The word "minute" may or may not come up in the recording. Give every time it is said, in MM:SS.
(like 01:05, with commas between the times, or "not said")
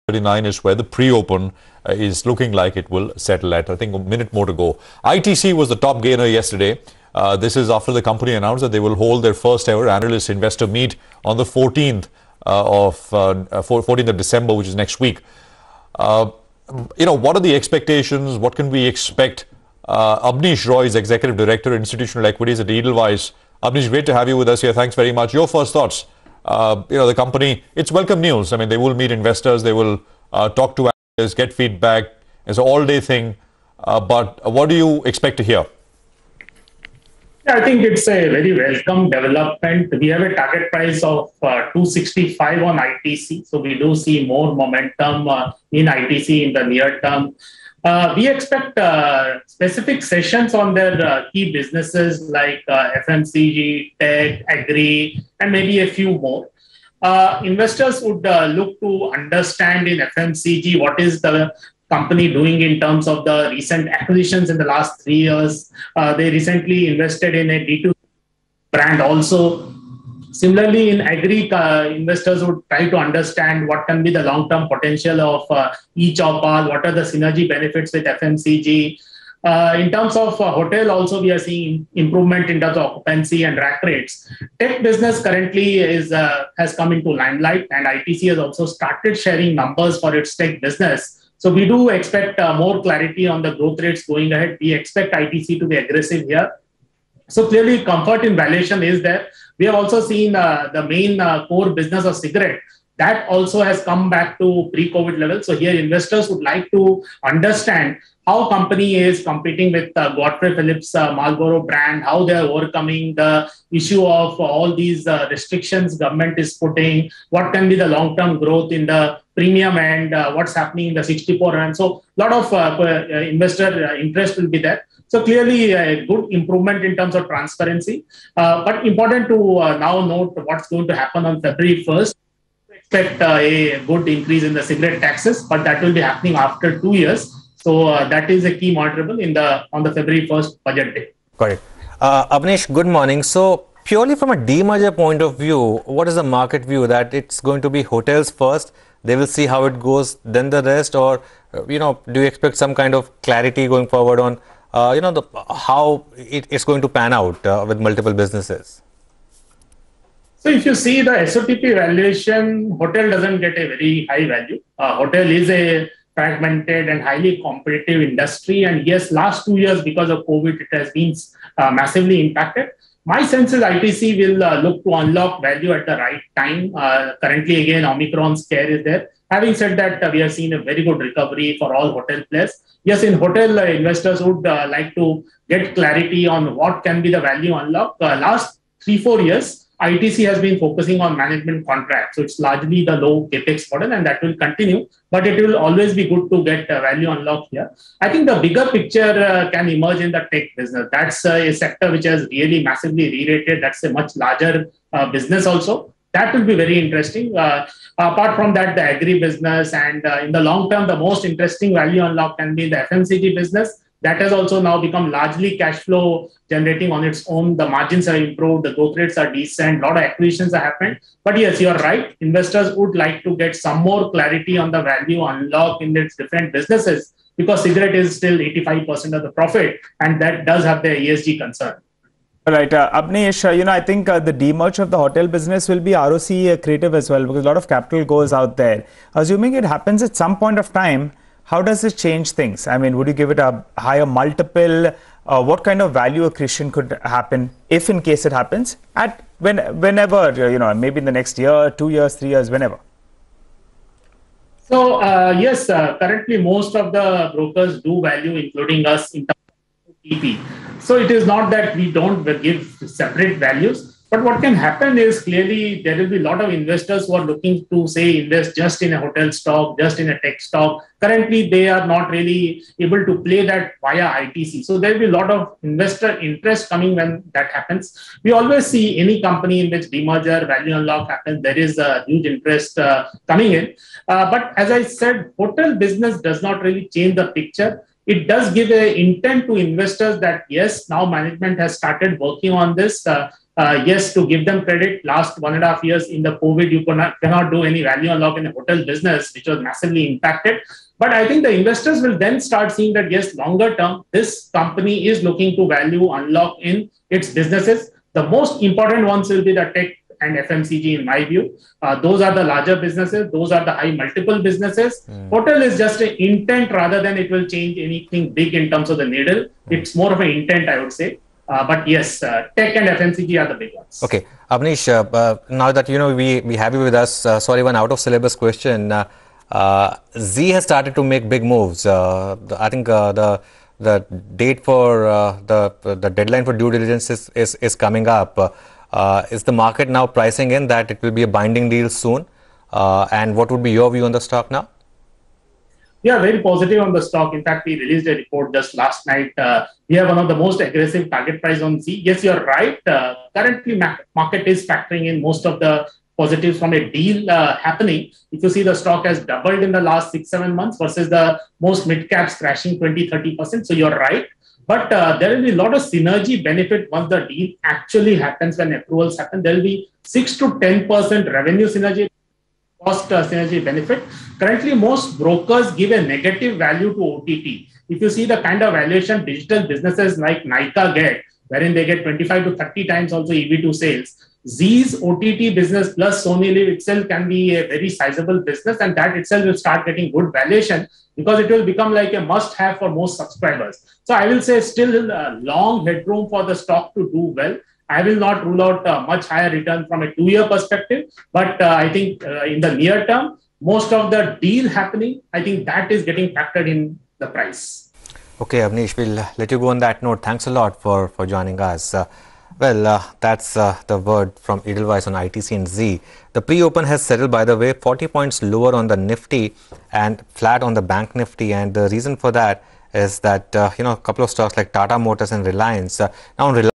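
00:04.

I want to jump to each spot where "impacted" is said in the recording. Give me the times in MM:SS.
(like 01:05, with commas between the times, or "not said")
02:52, 05:00.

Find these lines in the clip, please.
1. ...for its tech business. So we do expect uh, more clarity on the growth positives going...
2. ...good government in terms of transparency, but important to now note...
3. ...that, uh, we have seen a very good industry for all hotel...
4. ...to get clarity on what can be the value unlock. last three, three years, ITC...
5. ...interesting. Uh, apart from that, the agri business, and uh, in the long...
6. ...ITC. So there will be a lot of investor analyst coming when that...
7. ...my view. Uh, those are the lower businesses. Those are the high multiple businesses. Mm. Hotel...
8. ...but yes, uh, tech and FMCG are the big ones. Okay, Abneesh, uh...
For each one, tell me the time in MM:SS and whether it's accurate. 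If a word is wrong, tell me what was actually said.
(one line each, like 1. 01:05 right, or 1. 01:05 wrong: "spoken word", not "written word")
1. 01:29 wrong: "rates", not "positives"
2. 02:06 wrong: "improvement", not "government"
3. 02:59 wrong: "recovery", not "industry"
4. 03:04 wrong: "four", not "three"
5. 03:26 right
6. 04:34 wrong: "interest", not "analyst"
7. 05:11 wrong: "larger", not "lower"
8. 05:21 right.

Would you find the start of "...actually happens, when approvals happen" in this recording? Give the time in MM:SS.
06:07.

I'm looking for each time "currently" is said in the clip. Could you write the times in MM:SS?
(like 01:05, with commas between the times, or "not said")
01:25, 02:57, 04:15, 04:30, 05:53, 06:14.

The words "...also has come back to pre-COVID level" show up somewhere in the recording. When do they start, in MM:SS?
01:43.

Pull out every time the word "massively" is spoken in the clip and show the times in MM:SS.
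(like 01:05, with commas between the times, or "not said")
02:51, 03:22, 04:59.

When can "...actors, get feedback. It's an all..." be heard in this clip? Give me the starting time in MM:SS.
00:30.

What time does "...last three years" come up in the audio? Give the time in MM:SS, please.
01:04.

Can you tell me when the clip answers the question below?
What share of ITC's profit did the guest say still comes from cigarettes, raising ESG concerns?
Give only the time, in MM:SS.
03:48.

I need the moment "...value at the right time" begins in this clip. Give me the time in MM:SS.
02:55.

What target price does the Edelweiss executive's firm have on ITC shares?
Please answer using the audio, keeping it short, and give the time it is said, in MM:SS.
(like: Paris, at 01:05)
265, at 00:41.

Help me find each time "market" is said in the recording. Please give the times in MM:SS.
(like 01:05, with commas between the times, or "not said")
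02:26, 05:39, 05:54.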